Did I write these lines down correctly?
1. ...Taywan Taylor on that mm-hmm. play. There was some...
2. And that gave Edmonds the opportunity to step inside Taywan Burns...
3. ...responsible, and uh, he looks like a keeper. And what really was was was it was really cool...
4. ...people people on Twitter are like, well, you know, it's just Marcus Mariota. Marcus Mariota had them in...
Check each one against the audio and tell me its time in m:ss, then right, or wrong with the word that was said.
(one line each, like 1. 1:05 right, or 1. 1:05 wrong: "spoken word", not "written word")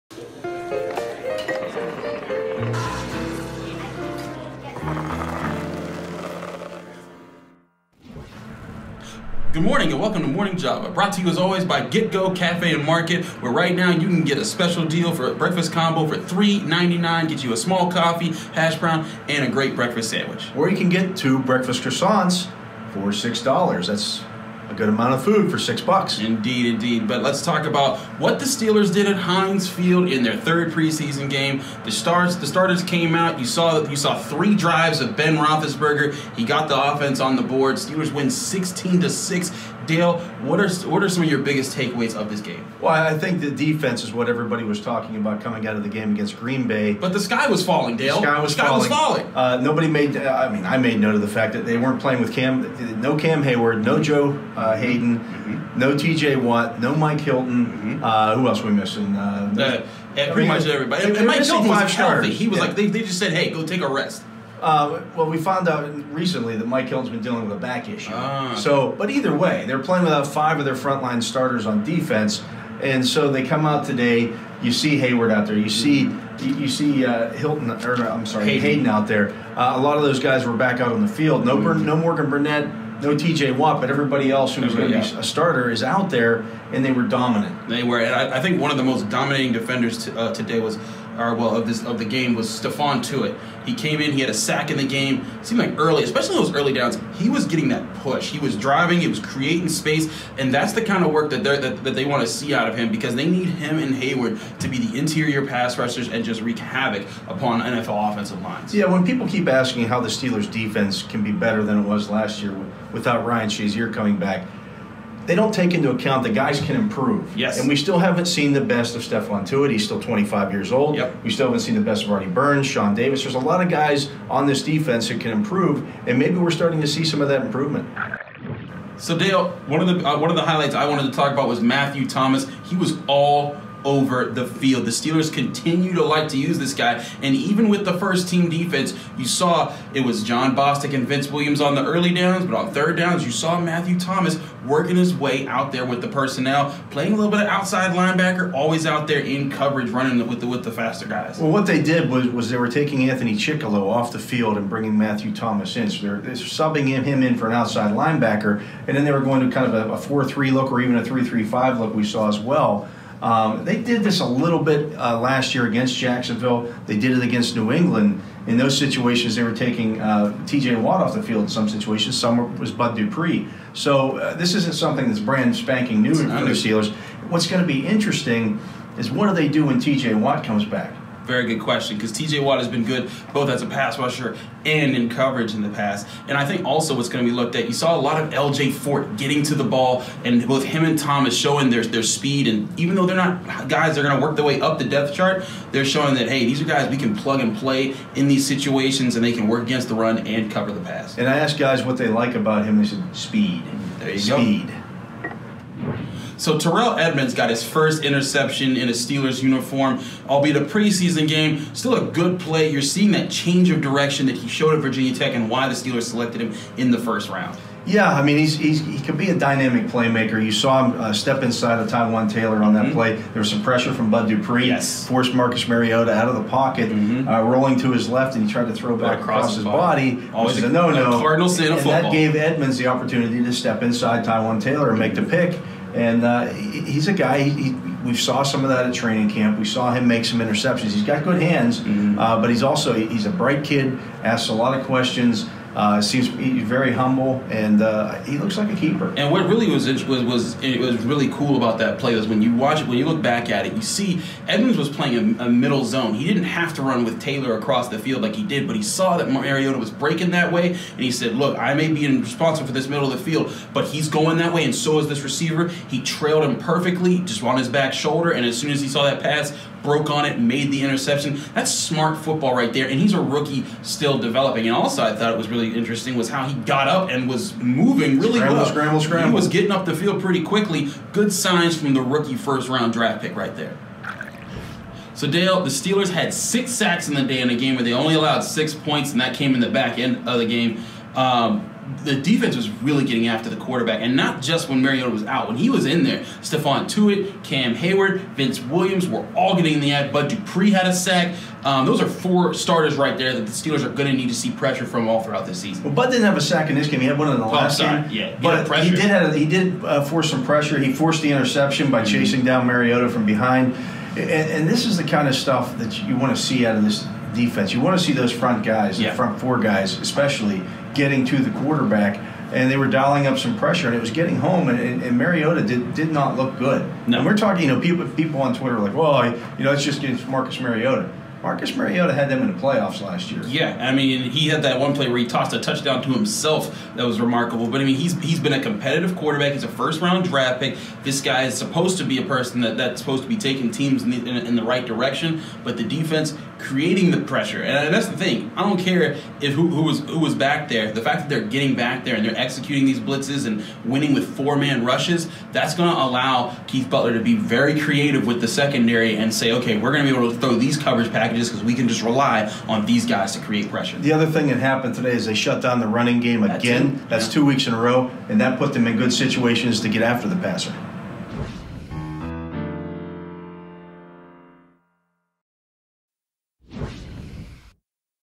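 1. 3:41 right
2. 3:51 wrong: "Taylor", not "Burns"
3. 4:06 wrong: "humble", not "responsible"
4. 5:27 right.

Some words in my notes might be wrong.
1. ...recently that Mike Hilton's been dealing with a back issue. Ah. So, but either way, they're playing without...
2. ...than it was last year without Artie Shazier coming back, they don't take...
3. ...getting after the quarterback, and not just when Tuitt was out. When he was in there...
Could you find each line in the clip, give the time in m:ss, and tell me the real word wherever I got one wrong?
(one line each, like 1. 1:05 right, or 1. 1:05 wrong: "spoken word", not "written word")
1. 1:06 right
2. 1:51 wrong: "Ryan", not "Artie"
3. 4:53 wrong: "Mariota", not "Tuitt".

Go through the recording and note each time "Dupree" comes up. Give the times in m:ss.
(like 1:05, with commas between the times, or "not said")
2:52, 3:44, 5:00.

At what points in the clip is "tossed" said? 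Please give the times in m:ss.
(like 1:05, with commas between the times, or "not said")
5:35.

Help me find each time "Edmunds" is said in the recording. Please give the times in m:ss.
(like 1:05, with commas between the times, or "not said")
3:26, 4:14.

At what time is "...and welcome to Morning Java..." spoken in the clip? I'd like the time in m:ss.
0:09.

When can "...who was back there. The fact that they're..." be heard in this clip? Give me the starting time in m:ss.
5:50.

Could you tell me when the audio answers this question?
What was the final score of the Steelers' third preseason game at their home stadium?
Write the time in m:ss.
0:38.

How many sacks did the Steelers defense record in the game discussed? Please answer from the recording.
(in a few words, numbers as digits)
6.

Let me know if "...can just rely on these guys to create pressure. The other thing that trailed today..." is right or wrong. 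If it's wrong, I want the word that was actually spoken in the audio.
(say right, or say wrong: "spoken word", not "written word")
wrong: "happened", not "trailed".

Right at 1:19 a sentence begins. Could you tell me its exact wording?
Uh, a lot of those guys were back out on the field.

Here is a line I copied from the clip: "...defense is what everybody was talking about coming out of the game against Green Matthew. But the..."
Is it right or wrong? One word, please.
wrong.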